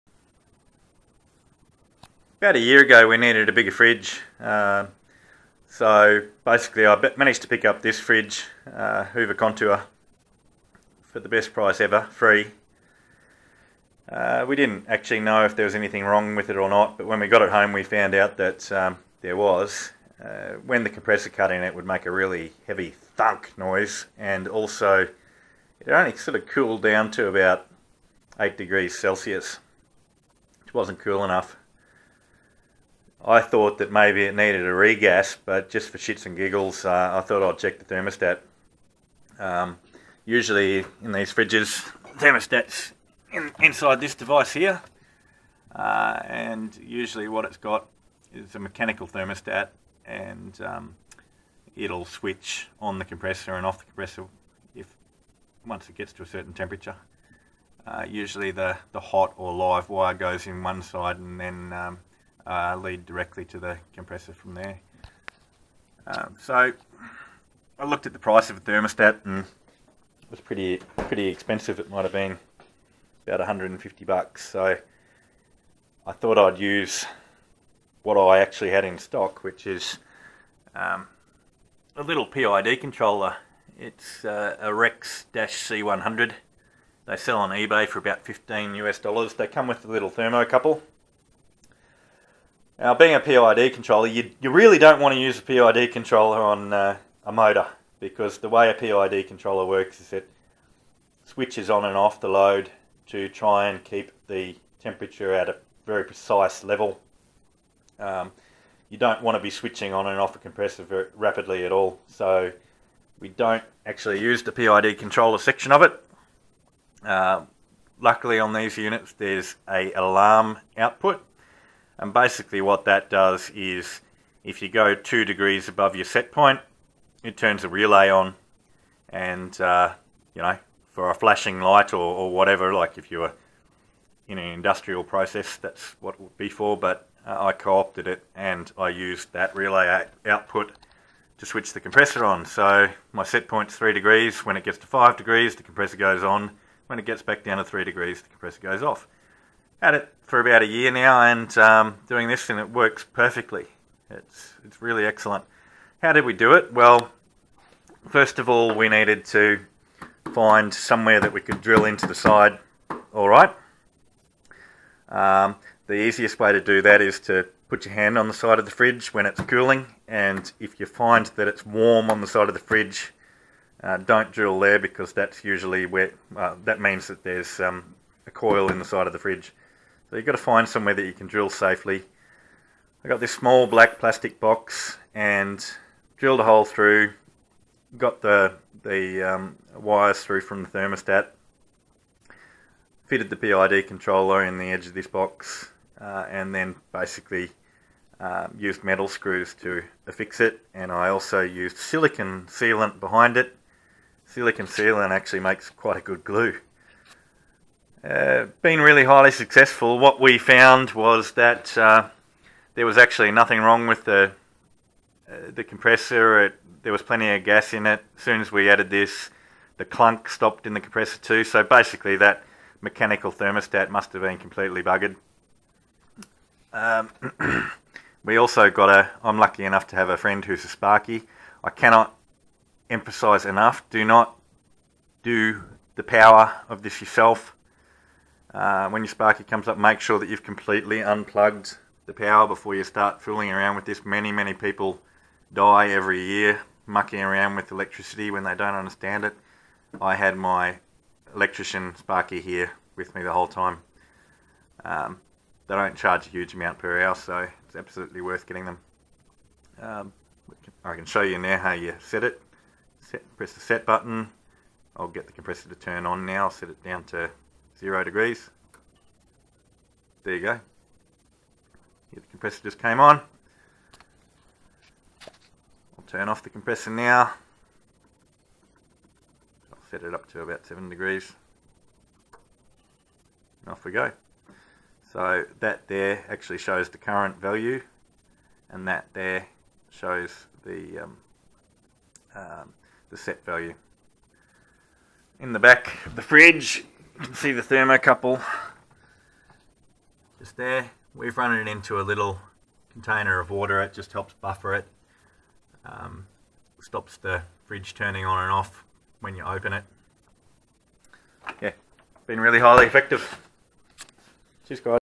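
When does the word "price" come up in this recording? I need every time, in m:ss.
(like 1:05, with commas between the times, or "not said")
0:11, 1:08.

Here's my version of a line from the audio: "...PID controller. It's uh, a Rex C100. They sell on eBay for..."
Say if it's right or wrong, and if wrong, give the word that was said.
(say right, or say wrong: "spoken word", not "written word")
right.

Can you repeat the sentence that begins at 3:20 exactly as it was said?
And I also used silicon sealant behind it.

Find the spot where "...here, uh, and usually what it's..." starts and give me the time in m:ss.
0:44.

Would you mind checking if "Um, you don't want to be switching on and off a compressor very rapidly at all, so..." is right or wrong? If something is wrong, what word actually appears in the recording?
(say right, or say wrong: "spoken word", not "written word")
right.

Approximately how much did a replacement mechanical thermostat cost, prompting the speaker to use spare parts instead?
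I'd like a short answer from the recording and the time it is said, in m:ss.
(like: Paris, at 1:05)
150 bucks, at 1:13.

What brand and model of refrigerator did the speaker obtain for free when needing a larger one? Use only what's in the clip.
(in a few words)
Hoover Contour.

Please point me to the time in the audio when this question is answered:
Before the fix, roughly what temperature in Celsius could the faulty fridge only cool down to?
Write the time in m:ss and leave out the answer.
0:28.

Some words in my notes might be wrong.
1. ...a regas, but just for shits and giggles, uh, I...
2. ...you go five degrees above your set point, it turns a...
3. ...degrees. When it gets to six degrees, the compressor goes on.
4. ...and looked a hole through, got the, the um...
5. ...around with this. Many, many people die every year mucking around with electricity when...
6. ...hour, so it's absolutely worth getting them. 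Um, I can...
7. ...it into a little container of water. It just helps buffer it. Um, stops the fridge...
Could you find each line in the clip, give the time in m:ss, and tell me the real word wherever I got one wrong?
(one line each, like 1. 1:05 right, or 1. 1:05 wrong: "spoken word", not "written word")
1. 0:34 right
2. 2:04 wrong: "two", not "five"
3. 2:23 wrong: "five", not "six"
4. 3:05 wrong: "drilled", not "looked"
5. 4:03 right
6. 4:17 right
7. 5:01 right.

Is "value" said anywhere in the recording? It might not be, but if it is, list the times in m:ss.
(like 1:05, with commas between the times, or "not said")
4:47, 4:53.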